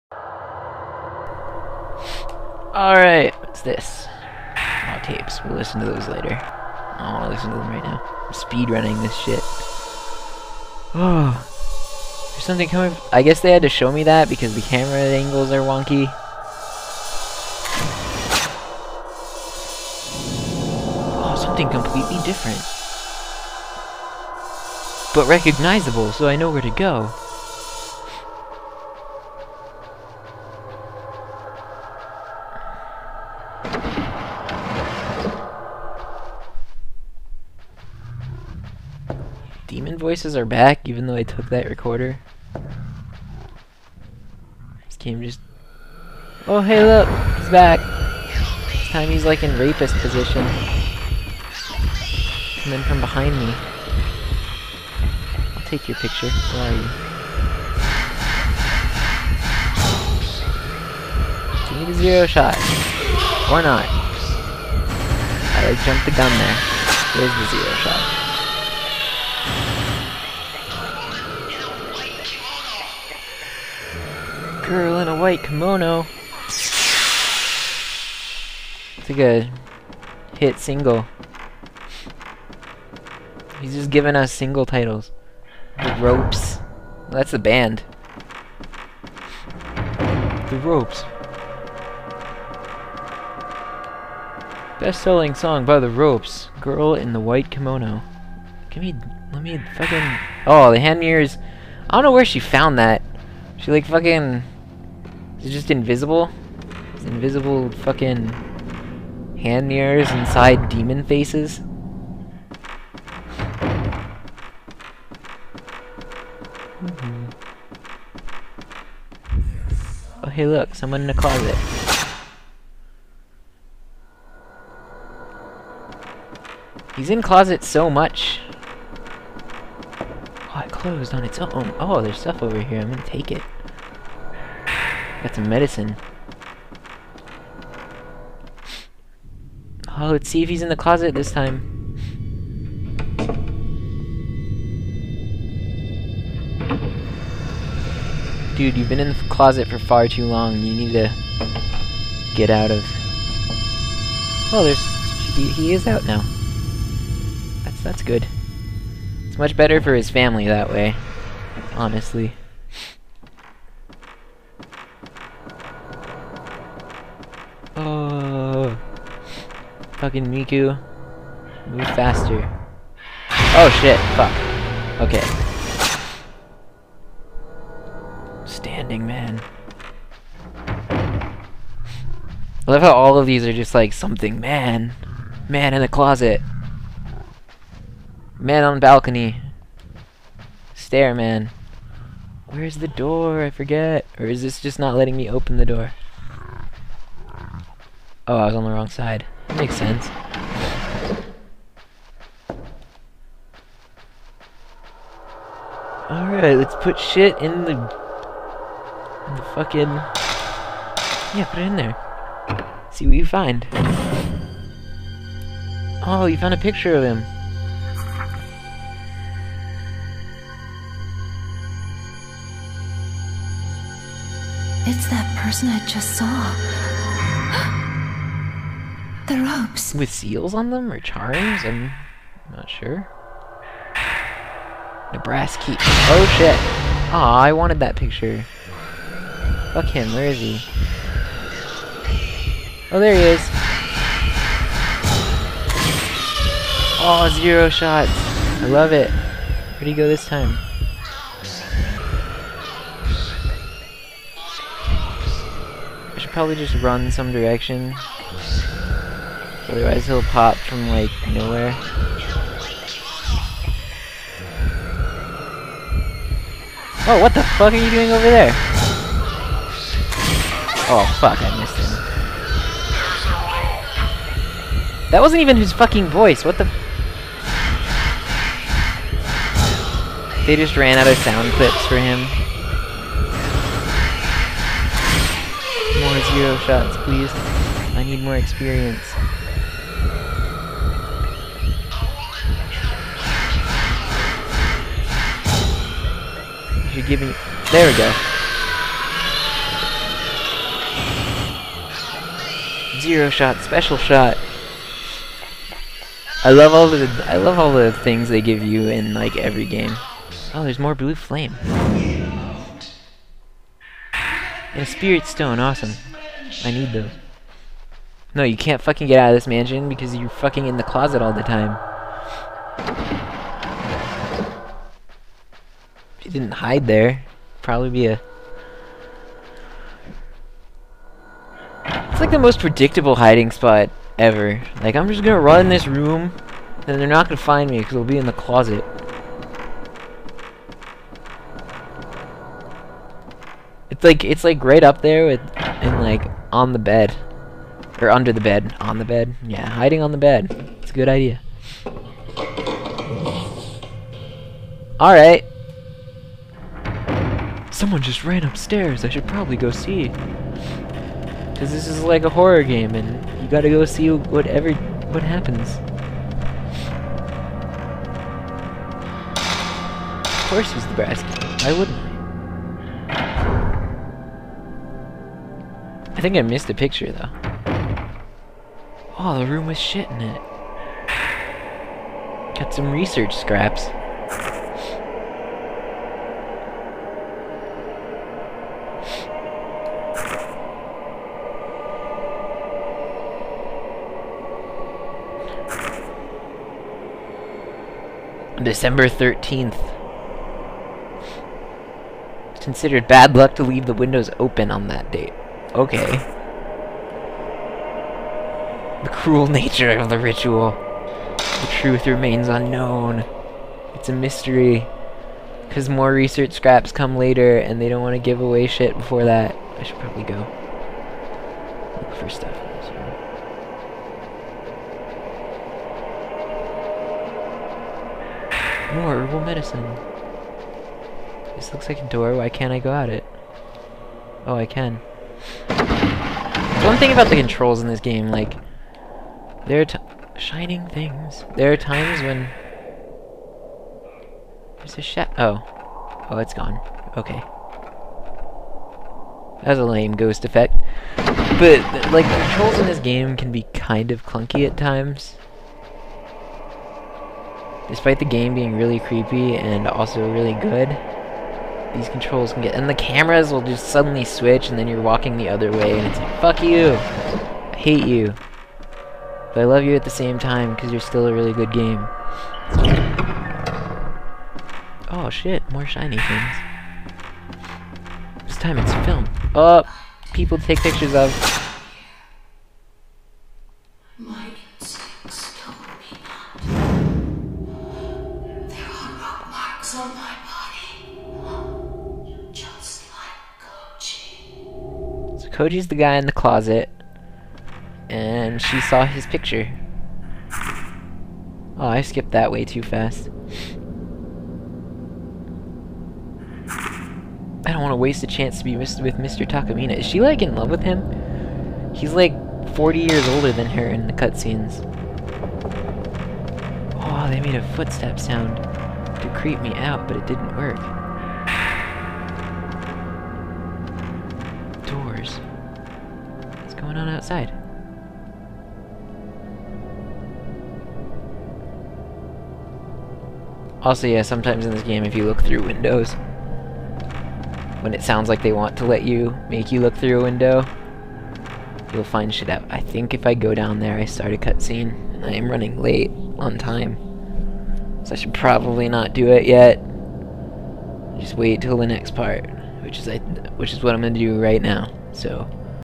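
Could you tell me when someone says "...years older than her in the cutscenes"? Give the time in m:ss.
8:32.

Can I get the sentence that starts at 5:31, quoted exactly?
It's like the most predictable hiding spot ever.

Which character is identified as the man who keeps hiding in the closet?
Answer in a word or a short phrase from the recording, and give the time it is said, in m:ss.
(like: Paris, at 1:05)
Koji, at 8:15.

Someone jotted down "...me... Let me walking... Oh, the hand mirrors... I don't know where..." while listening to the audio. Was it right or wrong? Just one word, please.
wrong.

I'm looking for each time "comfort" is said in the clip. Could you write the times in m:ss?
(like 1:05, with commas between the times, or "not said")
not said.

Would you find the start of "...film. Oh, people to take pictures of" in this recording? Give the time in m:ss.
7:59.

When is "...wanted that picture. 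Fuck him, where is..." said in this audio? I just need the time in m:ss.
3:57.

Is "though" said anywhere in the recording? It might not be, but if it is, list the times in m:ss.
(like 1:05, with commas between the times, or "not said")
0:41, 6:17.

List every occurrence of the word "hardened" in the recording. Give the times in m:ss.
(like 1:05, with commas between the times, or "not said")
not said.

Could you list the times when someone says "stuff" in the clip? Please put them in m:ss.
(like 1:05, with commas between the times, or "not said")
2:12, 7:02.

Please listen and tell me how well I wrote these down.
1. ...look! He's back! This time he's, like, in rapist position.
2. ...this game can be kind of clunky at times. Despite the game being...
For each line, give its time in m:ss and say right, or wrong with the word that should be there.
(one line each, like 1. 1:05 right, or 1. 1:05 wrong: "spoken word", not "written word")
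1. 0:46 right
2. 7:32 right.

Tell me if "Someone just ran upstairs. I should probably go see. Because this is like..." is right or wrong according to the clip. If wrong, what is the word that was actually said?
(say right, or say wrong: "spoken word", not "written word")
right.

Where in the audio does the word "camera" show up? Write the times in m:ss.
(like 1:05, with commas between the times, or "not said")
0:14, 7:42.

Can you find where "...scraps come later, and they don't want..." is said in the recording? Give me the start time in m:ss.
6:56.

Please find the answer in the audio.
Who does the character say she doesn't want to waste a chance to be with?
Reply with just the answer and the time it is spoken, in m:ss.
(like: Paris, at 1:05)
Mr. Takamine, at 8:28.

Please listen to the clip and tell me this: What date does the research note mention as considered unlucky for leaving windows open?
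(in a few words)
December 13th.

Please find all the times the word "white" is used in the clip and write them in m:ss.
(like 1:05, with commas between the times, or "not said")
1:15, 1:37.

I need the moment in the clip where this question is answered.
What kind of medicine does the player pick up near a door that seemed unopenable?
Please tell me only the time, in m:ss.
7:09.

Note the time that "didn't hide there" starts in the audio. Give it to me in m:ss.
5:26.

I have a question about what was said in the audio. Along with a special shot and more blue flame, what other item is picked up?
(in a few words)
spirit stone.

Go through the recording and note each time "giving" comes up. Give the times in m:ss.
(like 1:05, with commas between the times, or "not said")
1:23, 4:57.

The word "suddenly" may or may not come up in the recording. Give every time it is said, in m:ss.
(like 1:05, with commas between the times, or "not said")
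7:43.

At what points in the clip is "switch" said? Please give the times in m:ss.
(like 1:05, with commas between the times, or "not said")
7:44.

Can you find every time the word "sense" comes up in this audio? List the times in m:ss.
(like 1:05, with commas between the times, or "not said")
3:19.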